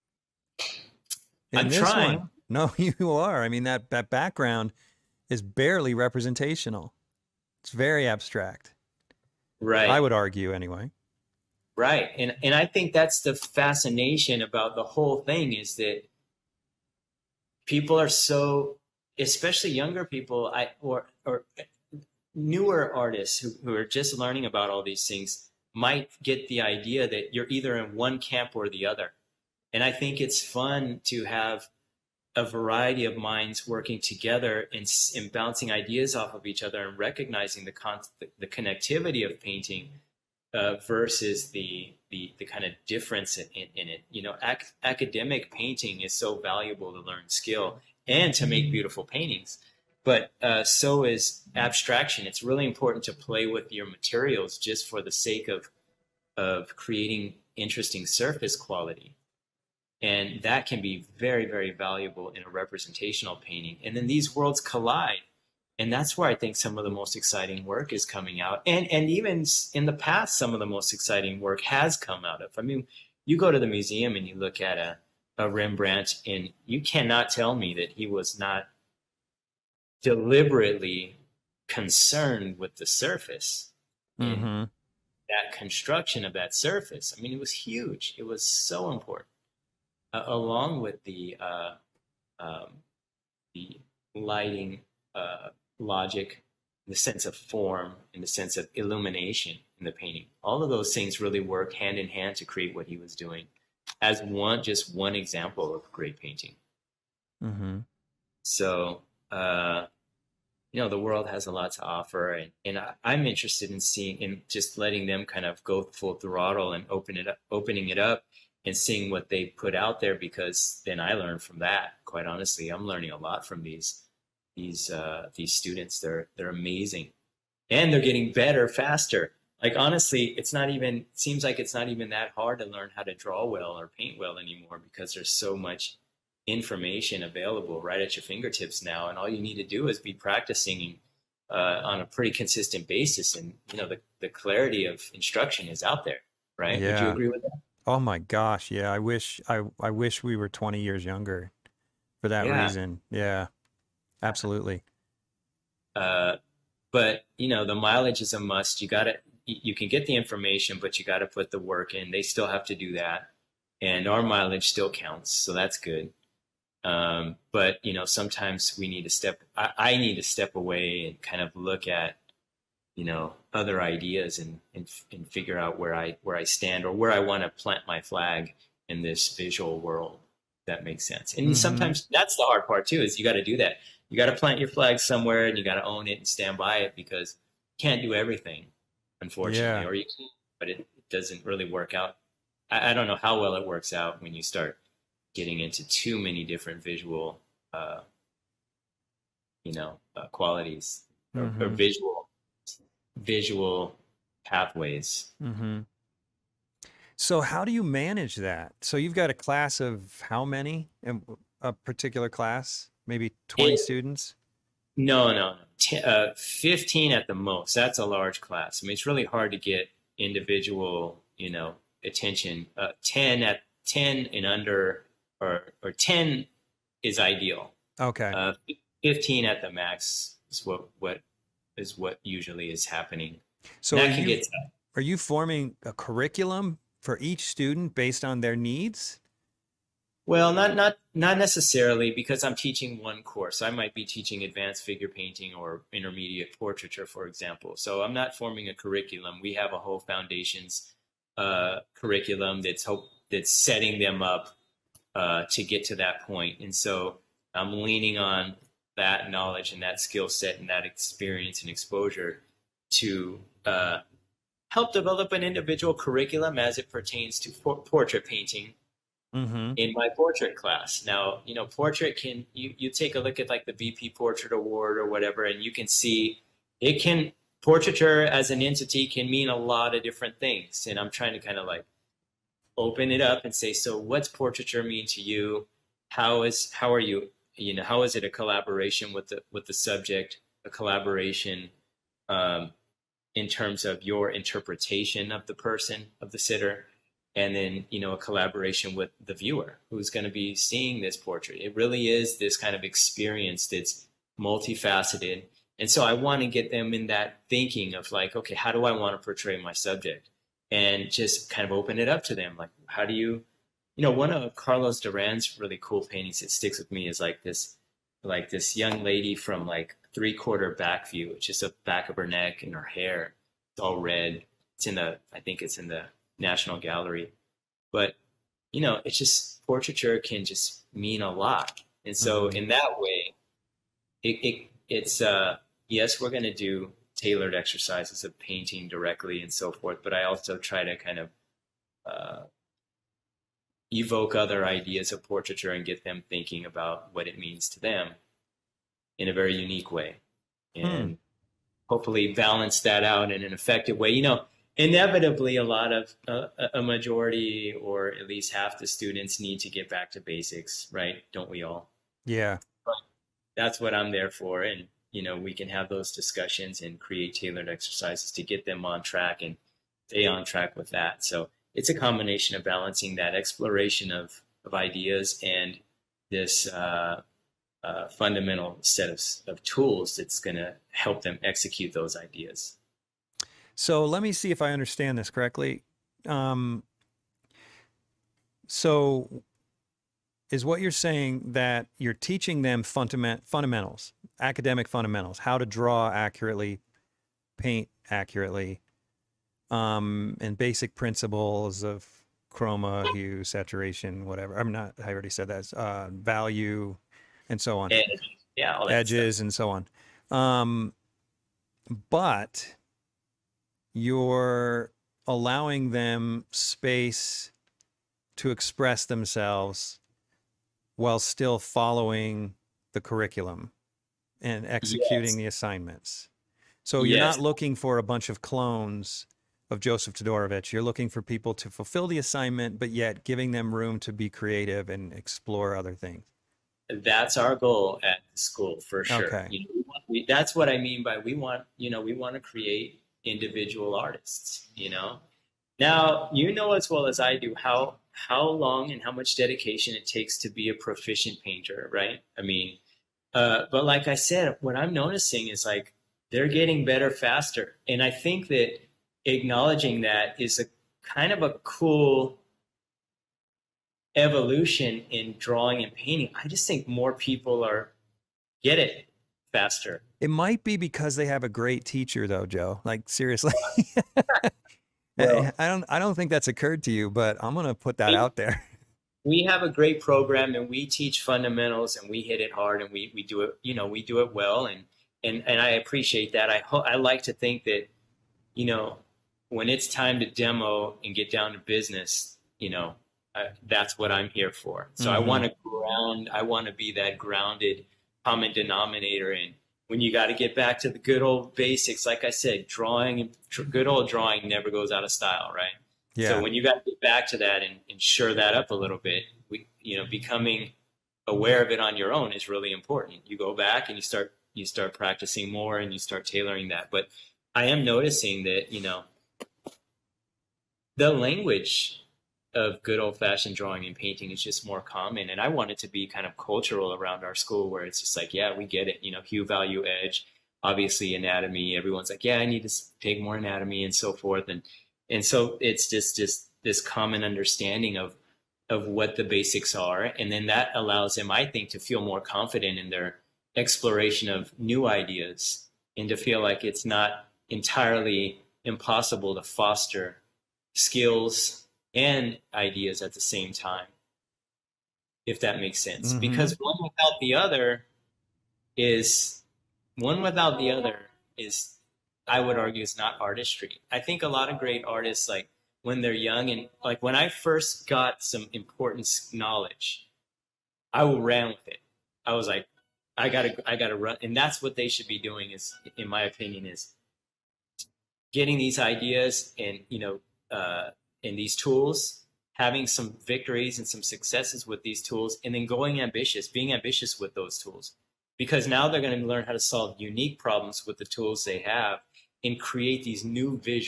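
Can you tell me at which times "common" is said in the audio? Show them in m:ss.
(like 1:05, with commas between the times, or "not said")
8:18, 8:44, 8:56.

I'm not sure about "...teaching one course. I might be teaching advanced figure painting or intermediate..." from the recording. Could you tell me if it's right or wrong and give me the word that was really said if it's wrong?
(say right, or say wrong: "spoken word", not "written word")
right.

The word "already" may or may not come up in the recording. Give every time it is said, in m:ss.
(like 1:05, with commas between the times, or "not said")
6:45.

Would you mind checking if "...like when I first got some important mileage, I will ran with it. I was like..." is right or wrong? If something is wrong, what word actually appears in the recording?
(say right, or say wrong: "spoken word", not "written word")
wrong: "knowledge", not "mileage".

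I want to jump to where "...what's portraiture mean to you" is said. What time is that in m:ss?
4:43.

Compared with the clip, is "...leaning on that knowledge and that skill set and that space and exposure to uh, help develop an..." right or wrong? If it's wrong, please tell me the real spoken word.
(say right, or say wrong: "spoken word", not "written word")
wrong: "experience", not "space".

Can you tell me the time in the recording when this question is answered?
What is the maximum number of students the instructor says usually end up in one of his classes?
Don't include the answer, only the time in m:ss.
3:49.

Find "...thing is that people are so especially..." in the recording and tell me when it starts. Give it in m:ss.
0:15.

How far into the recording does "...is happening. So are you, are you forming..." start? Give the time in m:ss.
3:52.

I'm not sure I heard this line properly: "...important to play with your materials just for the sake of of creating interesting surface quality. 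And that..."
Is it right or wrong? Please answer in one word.
right.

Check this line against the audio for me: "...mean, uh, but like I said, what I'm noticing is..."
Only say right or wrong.
right.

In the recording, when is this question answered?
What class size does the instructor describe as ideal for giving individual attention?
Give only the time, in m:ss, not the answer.
3:45.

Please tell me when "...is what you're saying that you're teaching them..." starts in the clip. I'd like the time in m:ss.
6:30.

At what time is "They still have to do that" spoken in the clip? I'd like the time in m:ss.
2:42.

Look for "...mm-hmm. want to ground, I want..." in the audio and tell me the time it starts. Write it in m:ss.
8:15.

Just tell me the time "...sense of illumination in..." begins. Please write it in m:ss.
1:38.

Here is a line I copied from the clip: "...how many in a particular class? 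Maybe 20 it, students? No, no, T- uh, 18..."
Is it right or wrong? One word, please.
wrong.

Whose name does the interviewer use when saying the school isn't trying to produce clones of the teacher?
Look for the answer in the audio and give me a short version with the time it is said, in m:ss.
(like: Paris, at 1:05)
Joseph Todorovitch, at 7:09.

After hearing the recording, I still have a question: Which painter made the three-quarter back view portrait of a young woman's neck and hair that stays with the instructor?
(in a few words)
Carlos Duran.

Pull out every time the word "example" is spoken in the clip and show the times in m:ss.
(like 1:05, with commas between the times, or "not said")
1:45, 4:07.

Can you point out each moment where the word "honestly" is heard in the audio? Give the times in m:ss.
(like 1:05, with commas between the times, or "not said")
2:02, 2:09.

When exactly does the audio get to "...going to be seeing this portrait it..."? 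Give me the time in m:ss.
5:00.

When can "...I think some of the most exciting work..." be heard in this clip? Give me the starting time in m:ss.
1:06.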